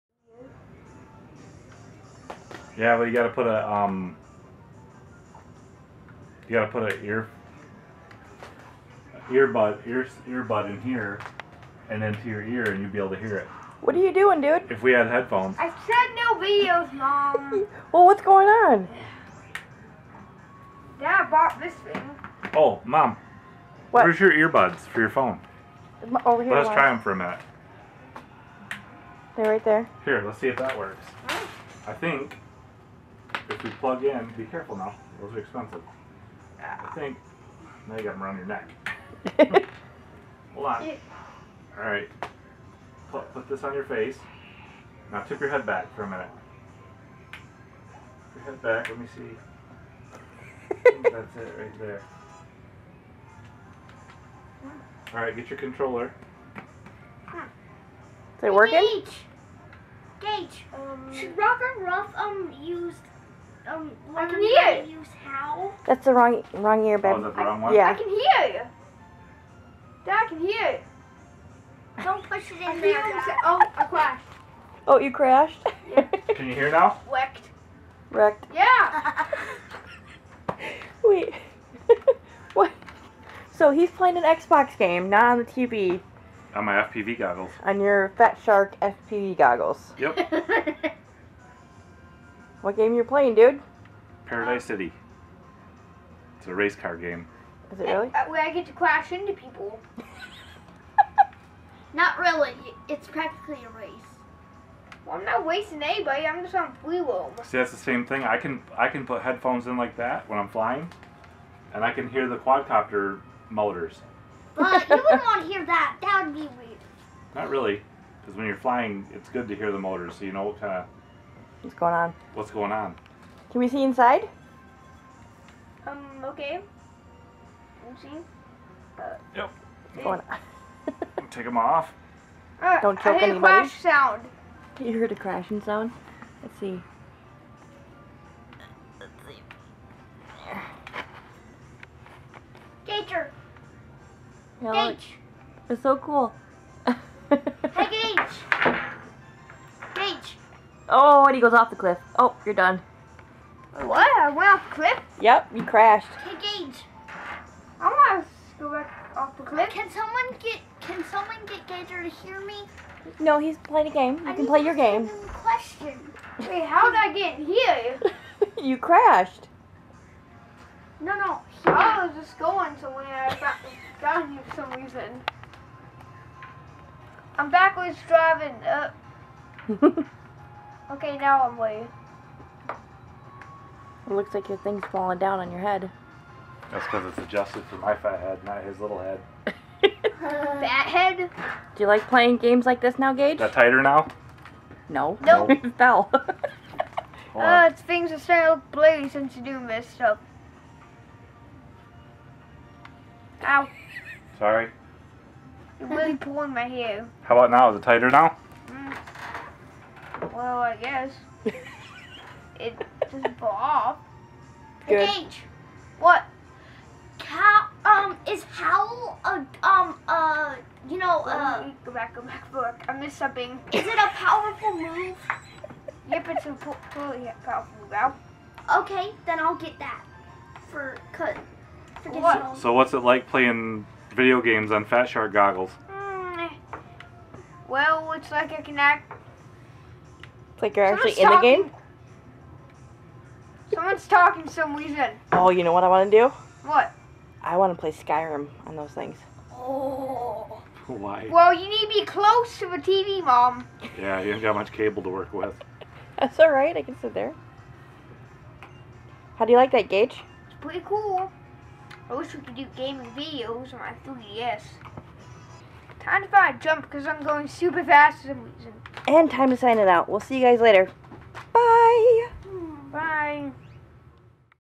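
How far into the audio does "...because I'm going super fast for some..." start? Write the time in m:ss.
4:26.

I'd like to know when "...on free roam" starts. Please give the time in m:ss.
1:46.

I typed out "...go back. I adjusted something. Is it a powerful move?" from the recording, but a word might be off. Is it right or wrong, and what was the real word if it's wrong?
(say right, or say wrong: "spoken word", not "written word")
wrong: "missed", not "adjusted".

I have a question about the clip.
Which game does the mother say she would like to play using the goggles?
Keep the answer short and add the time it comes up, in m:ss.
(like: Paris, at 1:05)
Skyrim, at 4:07.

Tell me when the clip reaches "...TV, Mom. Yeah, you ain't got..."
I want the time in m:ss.
4:12.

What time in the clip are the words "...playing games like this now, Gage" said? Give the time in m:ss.
3:12.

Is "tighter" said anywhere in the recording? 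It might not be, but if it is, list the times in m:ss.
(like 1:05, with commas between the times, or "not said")
3:13, 3:27.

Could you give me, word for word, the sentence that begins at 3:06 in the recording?
That's because it's adjusted for my fat head, not his little head.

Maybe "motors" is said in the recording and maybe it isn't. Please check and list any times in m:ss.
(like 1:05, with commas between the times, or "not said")
1:53, 1:59.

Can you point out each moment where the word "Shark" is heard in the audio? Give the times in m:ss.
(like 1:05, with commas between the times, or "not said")
1:28, 3:55.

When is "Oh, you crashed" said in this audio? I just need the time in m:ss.
1:14.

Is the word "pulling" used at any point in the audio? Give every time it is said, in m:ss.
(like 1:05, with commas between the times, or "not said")
3:26.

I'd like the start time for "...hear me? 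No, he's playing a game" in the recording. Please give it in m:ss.
2:42.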